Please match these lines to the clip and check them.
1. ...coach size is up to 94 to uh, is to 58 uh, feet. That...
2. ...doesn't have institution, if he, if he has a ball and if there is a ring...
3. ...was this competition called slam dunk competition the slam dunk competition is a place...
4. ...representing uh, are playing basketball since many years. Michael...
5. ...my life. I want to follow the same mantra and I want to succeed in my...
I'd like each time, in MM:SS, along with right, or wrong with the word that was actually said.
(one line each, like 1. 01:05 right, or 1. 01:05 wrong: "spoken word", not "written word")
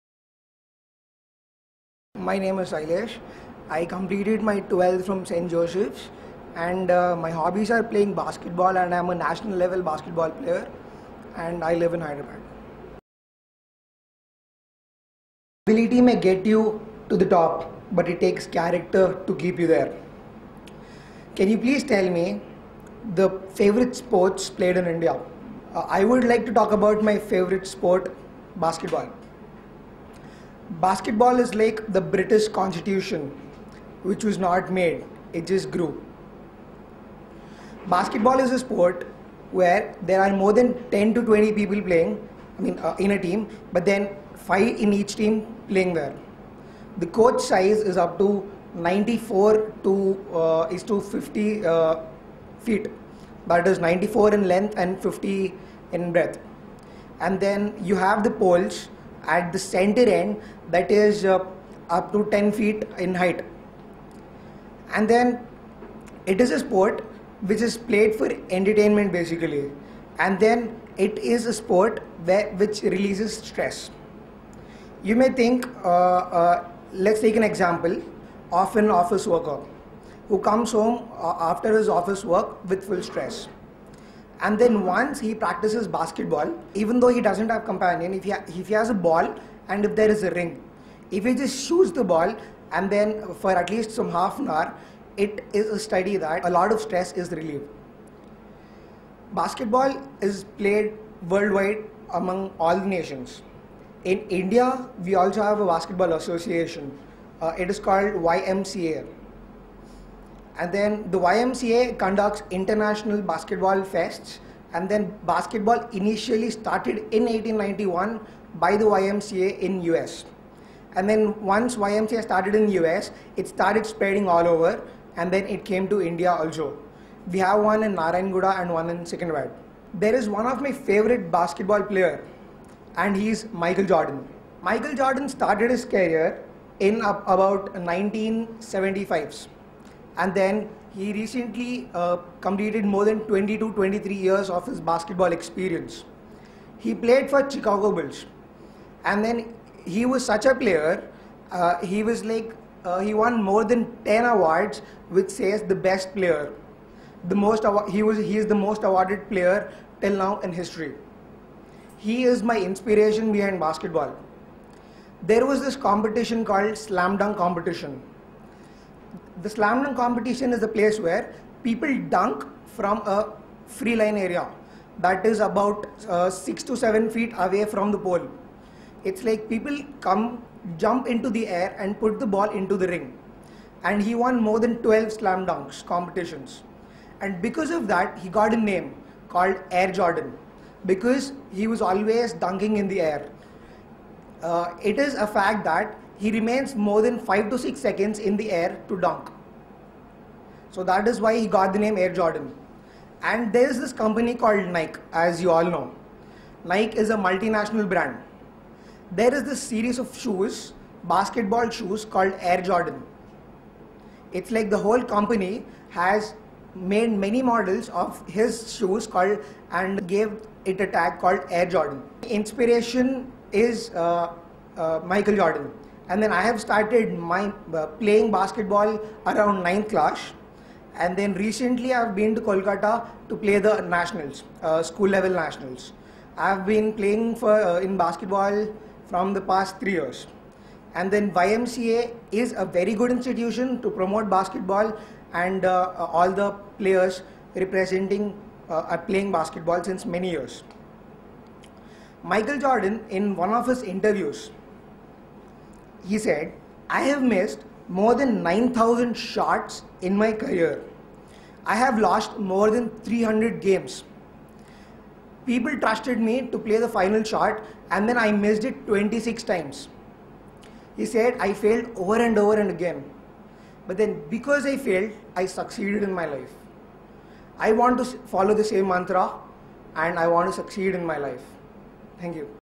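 1. 00:47 wrong: "50", not "58"
2. 01:27 wrong: "companion", not "institution"
3. 02:45 right
4. 04:07 right
5. 04:36 right.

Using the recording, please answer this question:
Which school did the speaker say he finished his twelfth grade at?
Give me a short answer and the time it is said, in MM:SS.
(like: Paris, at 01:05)
St. Joseph's, at 00:05.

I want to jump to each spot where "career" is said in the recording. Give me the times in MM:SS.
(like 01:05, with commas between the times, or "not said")
02:15, 04:20.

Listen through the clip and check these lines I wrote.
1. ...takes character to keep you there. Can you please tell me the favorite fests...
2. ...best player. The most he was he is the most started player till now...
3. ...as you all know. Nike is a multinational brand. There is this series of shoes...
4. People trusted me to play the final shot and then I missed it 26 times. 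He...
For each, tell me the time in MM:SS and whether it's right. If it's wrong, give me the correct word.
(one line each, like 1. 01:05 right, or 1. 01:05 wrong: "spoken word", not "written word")
1. 00:18 wrong: "sports", not "fests"
2. 02:35 wrong: "awarded", not "started"
3. 03:25 right
4. 04:25 right.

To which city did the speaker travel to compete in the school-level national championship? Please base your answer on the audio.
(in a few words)
Kolkata.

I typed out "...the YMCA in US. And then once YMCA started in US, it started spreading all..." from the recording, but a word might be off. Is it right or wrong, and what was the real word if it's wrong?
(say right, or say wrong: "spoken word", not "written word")
right.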